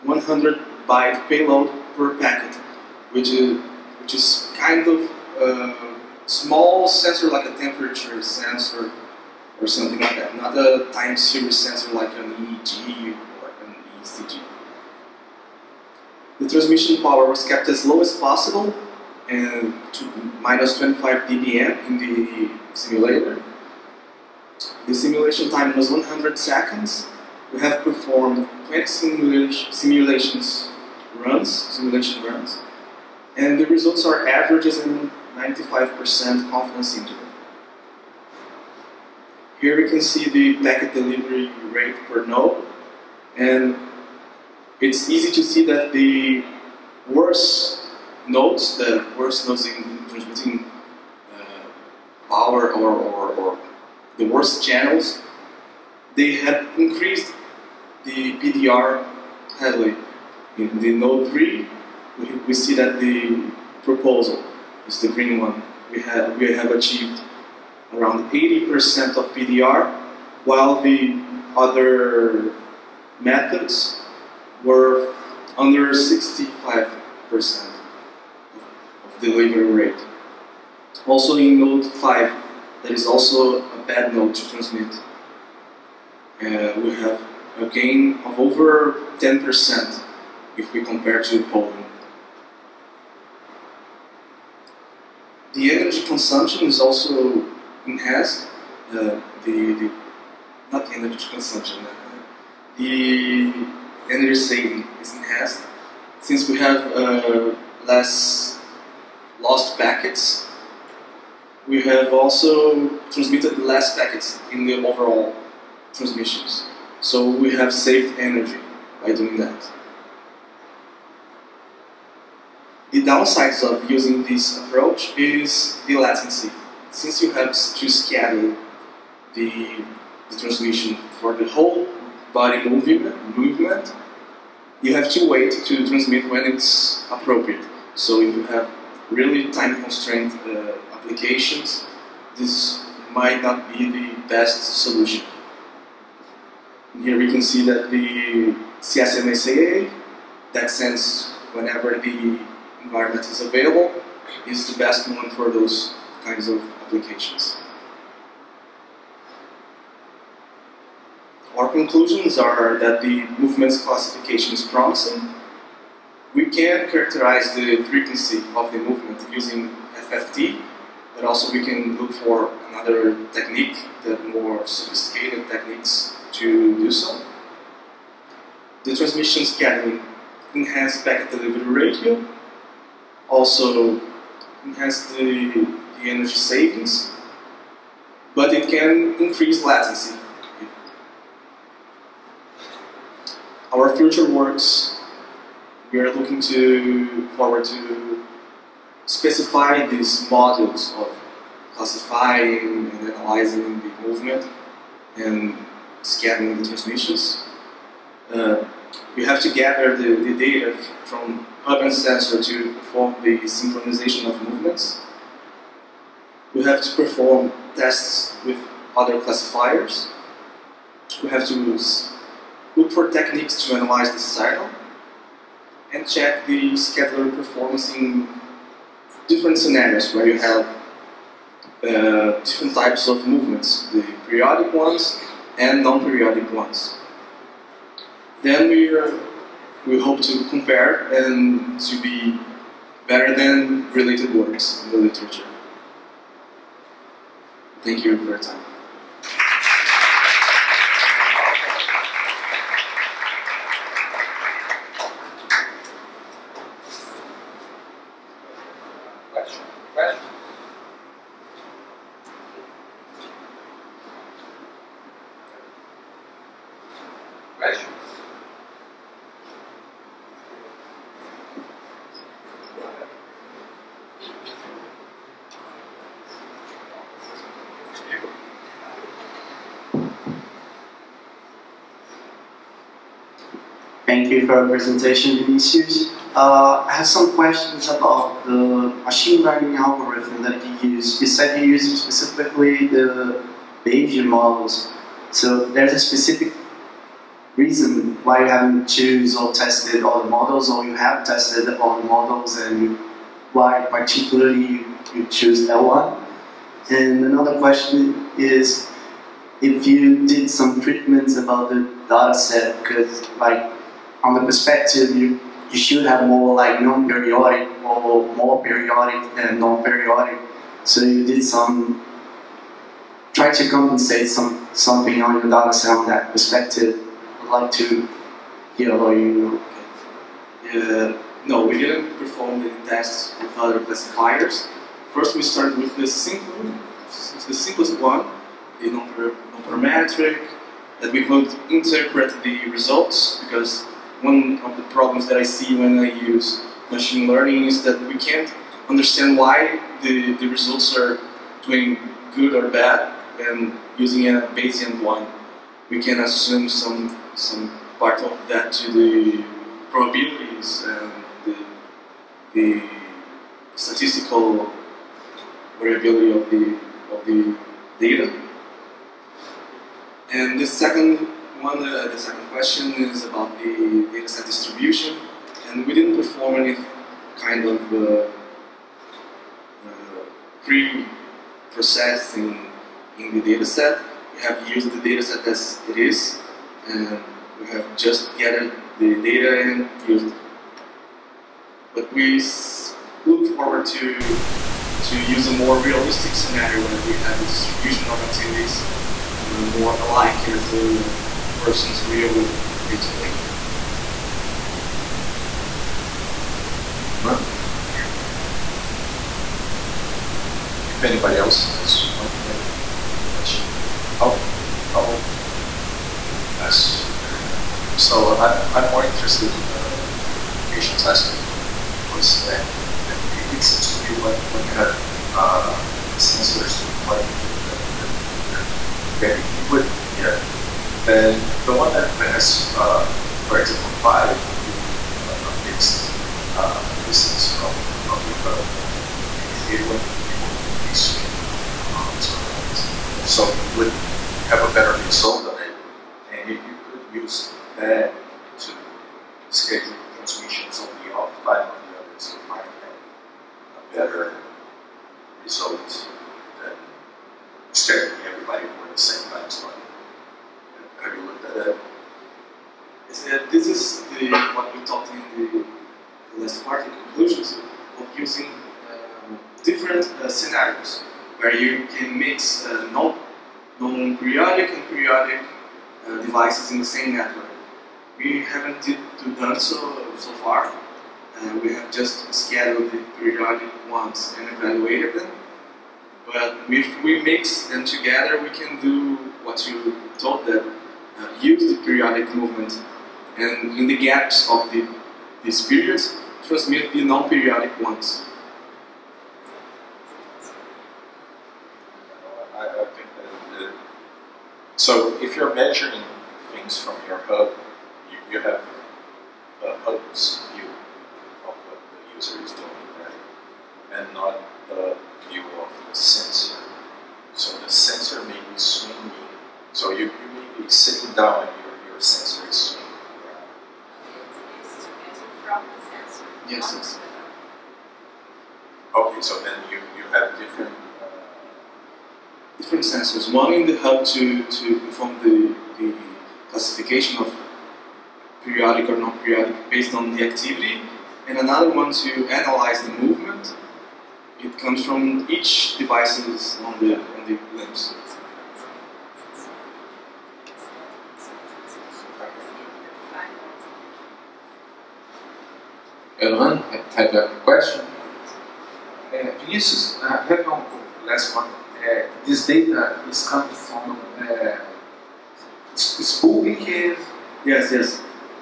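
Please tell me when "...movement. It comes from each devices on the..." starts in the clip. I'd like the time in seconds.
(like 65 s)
542 s.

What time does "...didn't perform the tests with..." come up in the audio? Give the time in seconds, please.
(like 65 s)
331 s.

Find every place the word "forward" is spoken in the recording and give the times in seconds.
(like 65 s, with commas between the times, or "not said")
197 s, 393 s.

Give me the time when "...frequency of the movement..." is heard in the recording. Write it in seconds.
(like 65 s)
167 s.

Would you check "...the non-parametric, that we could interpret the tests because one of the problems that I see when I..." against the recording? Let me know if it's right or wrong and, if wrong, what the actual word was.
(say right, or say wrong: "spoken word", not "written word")
wrong: "results", not "tests".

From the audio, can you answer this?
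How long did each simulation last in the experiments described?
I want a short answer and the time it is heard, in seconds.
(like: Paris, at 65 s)
100 seconds, at 25 s.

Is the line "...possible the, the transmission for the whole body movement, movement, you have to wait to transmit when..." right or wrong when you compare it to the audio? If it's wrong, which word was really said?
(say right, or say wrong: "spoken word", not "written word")
wrong: "schedule", not "possible".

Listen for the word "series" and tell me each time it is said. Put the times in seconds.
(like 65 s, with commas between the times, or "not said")
11 s.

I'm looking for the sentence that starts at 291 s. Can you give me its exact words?
You said you use specifically the Bayesian models.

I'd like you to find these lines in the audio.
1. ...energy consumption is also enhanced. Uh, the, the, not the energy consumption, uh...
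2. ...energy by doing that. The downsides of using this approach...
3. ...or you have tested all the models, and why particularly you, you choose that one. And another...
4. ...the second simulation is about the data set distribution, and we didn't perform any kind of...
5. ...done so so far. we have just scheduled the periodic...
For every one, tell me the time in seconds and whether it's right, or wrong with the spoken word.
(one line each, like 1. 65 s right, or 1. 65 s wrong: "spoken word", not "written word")
1. 95 s right
2. 118 s right
3. 300 s right
4. 372 s wrong: "question", not "simulation"
5. 479 s right.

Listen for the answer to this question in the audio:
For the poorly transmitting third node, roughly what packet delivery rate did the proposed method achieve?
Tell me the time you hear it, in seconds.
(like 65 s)
68 s.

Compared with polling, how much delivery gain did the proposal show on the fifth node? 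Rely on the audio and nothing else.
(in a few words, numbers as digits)
over 10%.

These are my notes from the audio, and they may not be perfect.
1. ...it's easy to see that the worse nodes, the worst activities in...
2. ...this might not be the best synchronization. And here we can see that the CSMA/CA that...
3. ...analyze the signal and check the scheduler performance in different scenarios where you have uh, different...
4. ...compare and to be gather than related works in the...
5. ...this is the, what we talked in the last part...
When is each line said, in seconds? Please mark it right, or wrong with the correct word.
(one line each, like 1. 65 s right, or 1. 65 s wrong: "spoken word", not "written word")
1. 44 s wrong: "nodes", not "activities"
2. 142 s wrong: "solution", not "synchronization"
3. 223 s right
4. 240 s wrong: "better", not "gather"
5. 463 s right.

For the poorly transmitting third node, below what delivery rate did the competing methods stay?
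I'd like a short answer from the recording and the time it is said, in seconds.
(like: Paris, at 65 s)
65%, at 75 s.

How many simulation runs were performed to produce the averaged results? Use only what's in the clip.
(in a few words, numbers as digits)
20.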